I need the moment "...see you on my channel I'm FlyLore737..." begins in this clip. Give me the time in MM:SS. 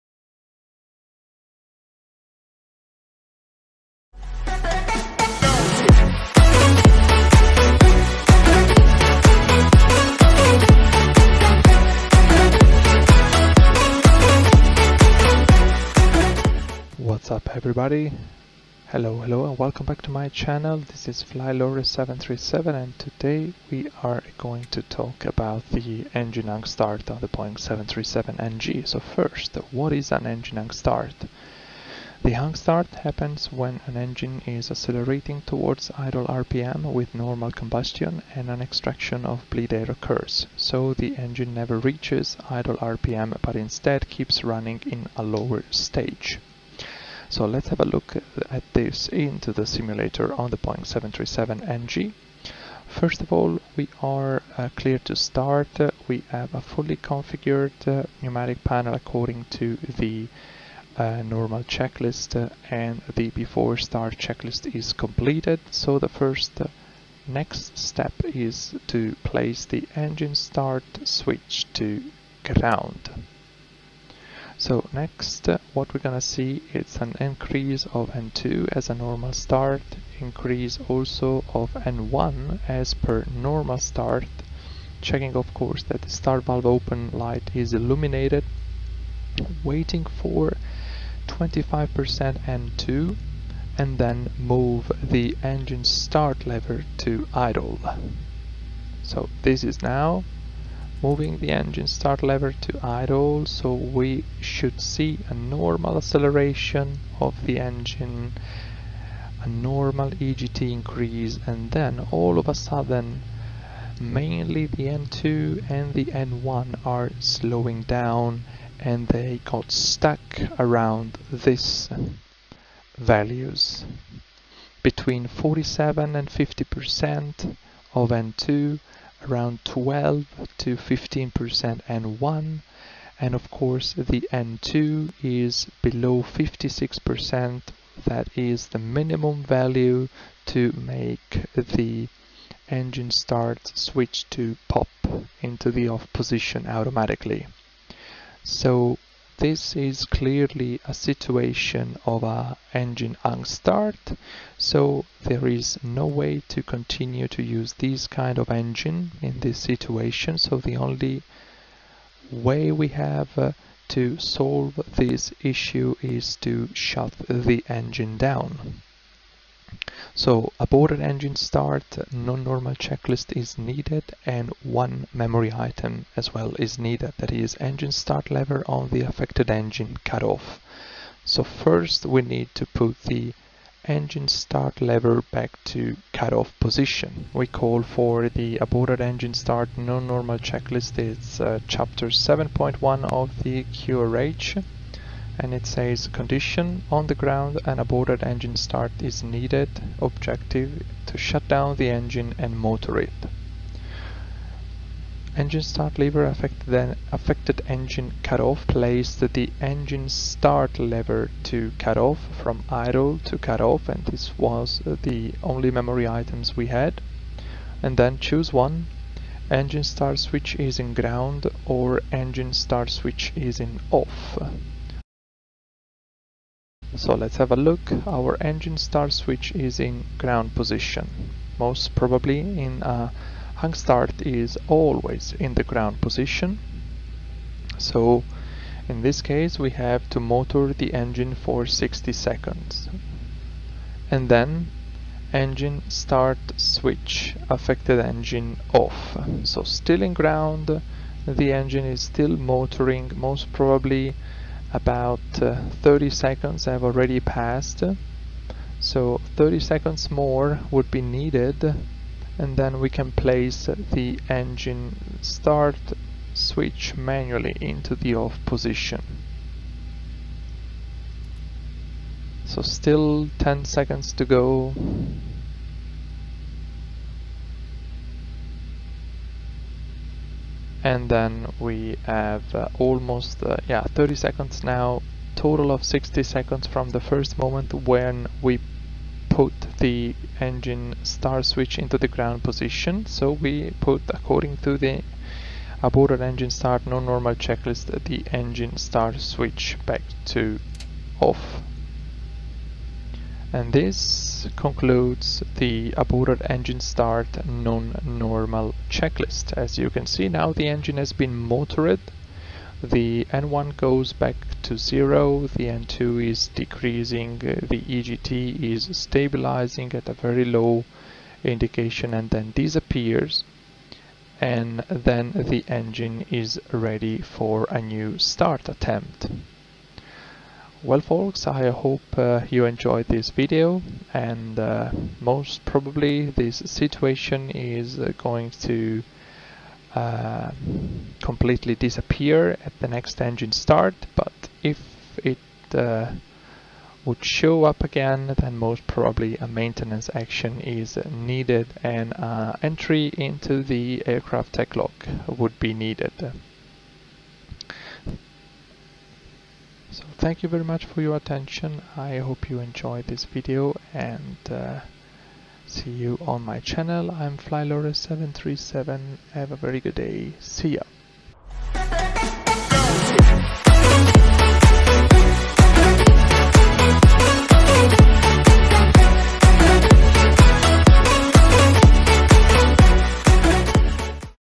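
06:05.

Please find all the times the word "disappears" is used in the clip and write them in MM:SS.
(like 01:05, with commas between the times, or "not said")
05:22, 05:41.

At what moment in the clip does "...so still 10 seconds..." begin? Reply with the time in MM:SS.
04:32.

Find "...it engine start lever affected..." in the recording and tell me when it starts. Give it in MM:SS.
03:22.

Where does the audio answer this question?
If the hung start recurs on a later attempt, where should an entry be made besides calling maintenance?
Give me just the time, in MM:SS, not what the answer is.
05:54.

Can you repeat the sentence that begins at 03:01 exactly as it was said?
So first we need to put the engine start lever back to cutoff position.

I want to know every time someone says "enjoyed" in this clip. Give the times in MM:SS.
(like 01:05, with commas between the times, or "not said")
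05:32, 06:02.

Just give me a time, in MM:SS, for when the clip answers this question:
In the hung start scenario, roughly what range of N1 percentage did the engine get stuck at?
02:09.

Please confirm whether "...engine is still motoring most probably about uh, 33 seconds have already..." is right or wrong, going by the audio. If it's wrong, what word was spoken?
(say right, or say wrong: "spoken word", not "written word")
wrong: "30", not "33".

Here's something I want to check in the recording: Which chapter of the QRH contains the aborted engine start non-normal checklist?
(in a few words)
7.1.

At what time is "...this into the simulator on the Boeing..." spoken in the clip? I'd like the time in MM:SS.
00:48.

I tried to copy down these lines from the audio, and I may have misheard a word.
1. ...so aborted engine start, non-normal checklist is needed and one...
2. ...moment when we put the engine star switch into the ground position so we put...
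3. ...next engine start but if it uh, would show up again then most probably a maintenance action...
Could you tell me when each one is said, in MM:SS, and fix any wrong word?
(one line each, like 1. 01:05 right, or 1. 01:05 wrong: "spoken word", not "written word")
1. 02:50 right
2. 04:47 right
3. 05:42 right.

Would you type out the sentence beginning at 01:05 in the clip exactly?
So the first uh, next step is to place the engine start switch to ground.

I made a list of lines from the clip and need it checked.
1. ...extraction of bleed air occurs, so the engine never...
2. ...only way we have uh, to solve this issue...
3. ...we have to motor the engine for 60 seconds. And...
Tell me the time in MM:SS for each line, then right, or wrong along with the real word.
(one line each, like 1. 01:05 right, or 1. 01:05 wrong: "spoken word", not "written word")
1. 00:38 right
2. 02:40 right
3. 03:59 right.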